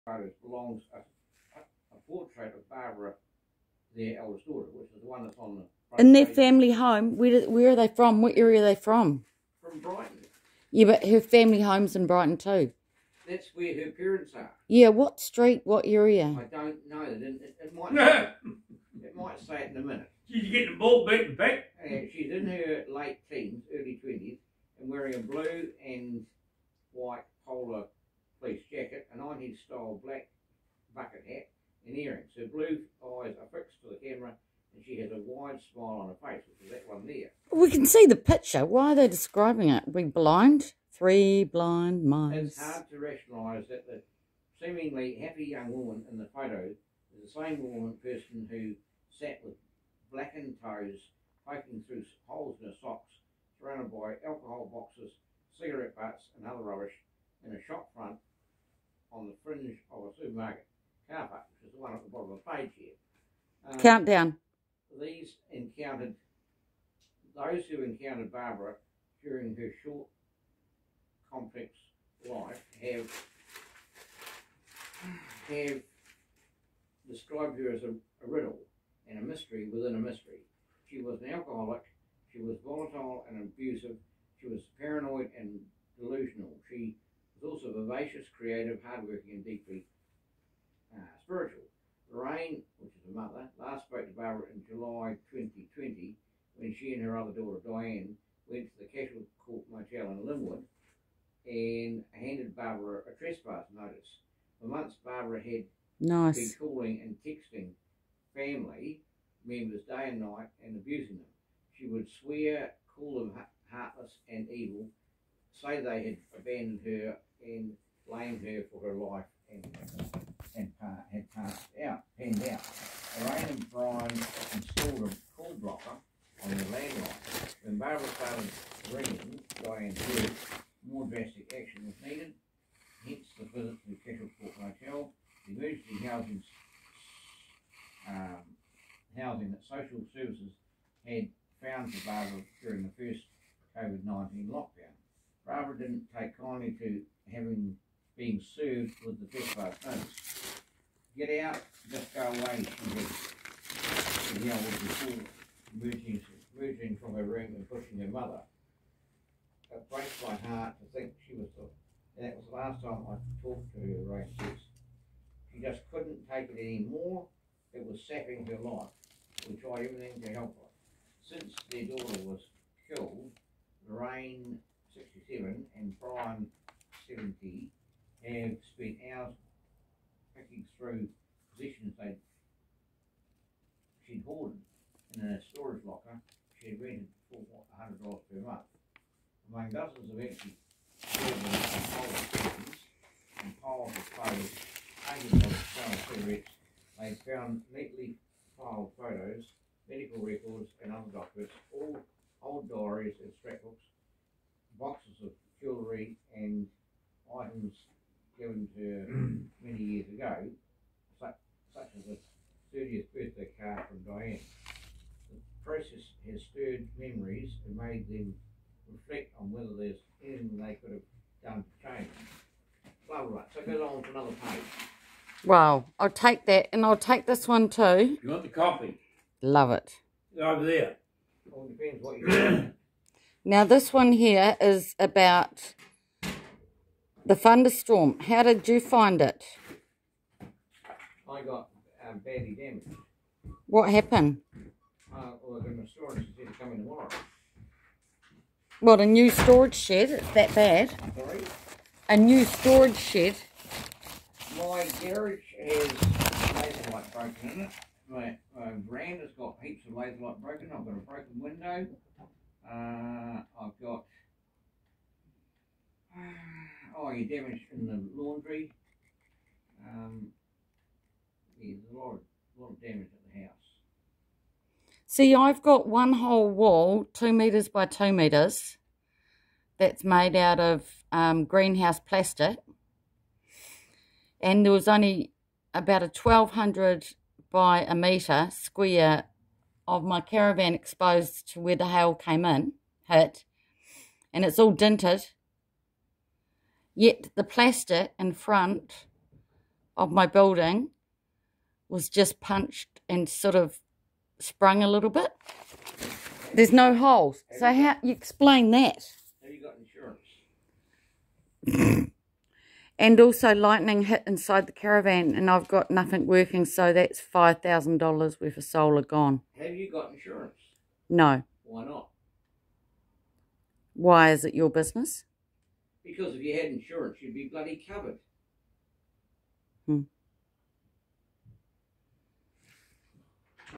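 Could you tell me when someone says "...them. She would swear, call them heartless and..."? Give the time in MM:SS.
01:51.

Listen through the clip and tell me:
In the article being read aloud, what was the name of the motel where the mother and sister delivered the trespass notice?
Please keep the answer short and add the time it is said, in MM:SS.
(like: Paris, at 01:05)
Casual Court Motel, at 01:38.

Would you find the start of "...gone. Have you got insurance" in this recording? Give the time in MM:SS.
05:19.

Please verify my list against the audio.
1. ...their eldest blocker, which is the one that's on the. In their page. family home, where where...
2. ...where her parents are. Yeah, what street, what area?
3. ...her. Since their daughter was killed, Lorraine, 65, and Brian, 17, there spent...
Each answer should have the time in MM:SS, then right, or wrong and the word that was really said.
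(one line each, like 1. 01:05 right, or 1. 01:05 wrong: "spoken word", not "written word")
1. 00:03 wrong: "daughter", not "blocker"
2. 00:13 right
3. 02:50 wrong: "67", not "65".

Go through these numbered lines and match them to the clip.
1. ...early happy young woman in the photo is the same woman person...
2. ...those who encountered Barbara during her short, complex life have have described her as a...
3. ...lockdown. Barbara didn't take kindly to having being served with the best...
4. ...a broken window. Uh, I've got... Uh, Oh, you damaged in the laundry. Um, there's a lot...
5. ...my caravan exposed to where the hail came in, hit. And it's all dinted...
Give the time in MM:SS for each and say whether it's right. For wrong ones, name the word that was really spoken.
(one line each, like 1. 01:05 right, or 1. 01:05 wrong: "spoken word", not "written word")
1. 00:44 wrong: "seemingly", not "early"
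2. 01:07 right
3. 02:24 right
4. 04:20 right
5. 04:50 right.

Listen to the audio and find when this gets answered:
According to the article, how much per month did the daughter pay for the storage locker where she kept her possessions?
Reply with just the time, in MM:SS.
03:07.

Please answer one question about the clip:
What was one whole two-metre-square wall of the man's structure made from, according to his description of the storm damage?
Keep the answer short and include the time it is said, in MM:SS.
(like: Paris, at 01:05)
Greenhouse plastic, at 04:41.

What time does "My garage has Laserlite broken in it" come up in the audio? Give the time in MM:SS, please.
04:14.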